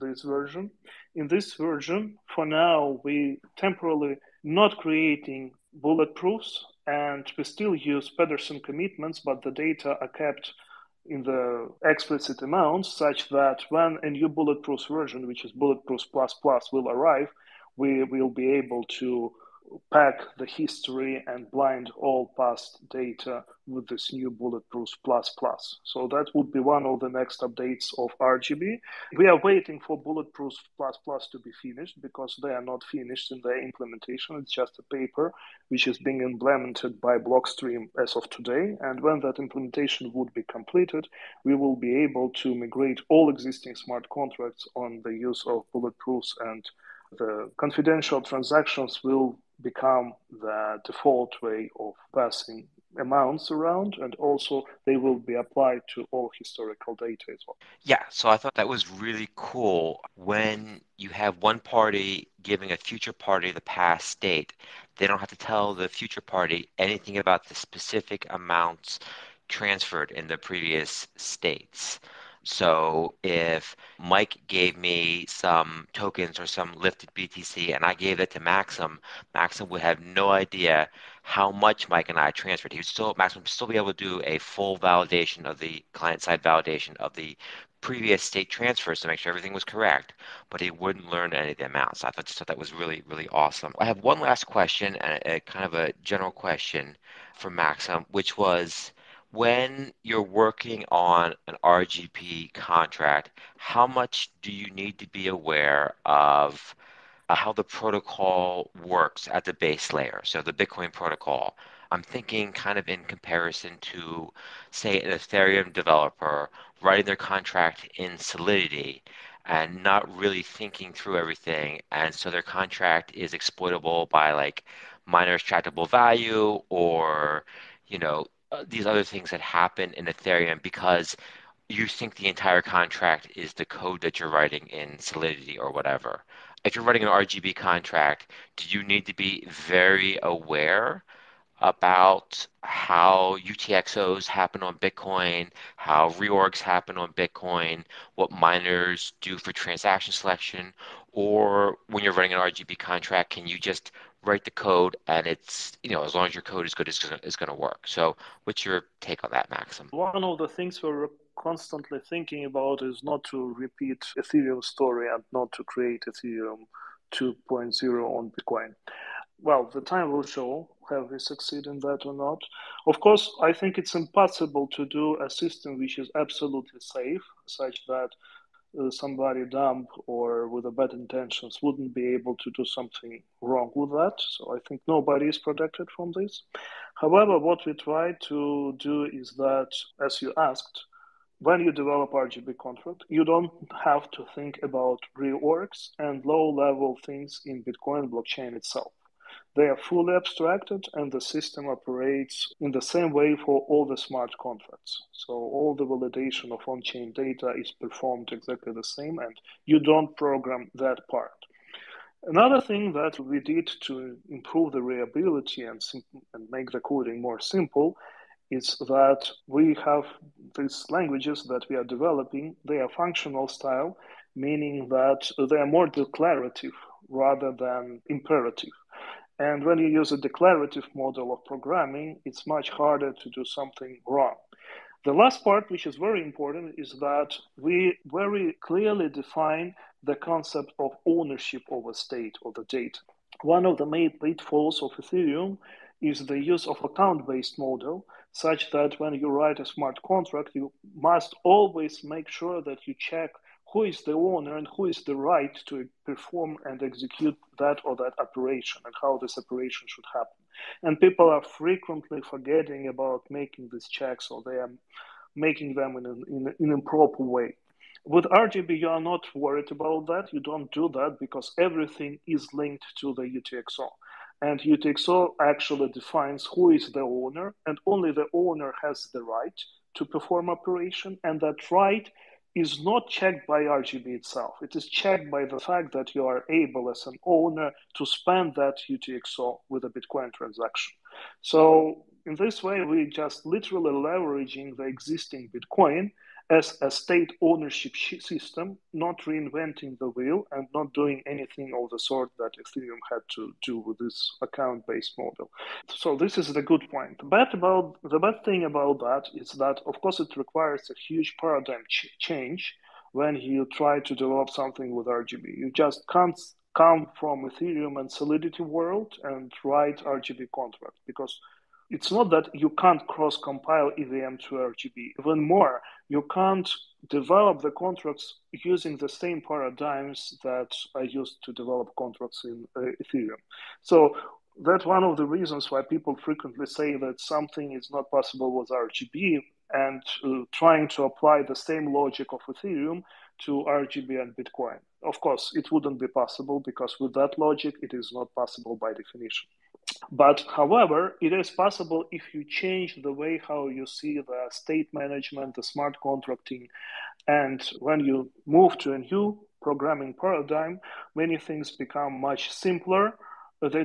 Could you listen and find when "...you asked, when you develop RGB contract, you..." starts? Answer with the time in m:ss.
3:10.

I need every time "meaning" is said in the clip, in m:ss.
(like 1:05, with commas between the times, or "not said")
3:44.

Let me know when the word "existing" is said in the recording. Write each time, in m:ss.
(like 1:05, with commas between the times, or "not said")
0:43, 4:54.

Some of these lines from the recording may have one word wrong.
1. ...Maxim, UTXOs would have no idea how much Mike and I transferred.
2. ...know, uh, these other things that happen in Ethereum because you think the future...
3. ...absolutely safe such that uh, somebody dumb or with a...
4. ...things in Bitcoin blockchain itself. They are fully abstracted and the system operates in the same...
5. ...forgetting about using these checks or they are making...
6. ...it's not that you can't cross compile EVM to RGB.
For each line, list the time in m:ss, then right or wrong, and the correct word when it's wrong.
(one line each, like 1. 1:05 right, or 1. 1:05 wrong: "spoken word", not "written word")
1. 1:18 wrong: "Maxim", not "UTXOs"
2. 2:07 wrong: "entire", not "future"
3. 2:56 right
4. 3:17 right
5. 4:22 wrong: "making", not "using"
6. 5:21 right.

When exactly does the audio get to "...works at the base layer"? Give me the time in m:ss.
1:48.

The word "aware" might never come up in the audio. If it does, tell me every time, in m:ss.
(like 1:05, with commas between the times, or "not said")
1:45, 2:20.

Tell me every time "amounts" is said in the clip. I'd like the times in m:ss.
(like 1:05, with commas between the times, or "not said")
0:12, 0:52, 1:08, 1:31.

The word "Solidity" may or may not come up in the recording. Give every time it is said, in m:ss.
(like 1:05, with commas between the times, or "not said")
1:58, 2:15, 5:18.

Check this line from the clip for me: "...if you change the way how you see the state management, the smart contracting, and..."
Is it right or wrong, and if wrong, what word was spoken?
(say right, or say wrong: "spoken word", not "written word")
right.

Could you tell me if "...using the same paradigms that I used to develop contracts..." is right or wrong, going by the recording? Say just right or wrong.
right.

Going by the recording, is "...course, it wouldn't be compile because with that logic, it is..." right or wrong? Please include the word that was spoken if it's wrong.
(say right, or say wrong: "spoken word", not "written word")
wrong: "possible", not "compile".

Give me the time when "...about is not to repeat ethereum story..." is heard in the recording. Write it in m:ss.
2:42.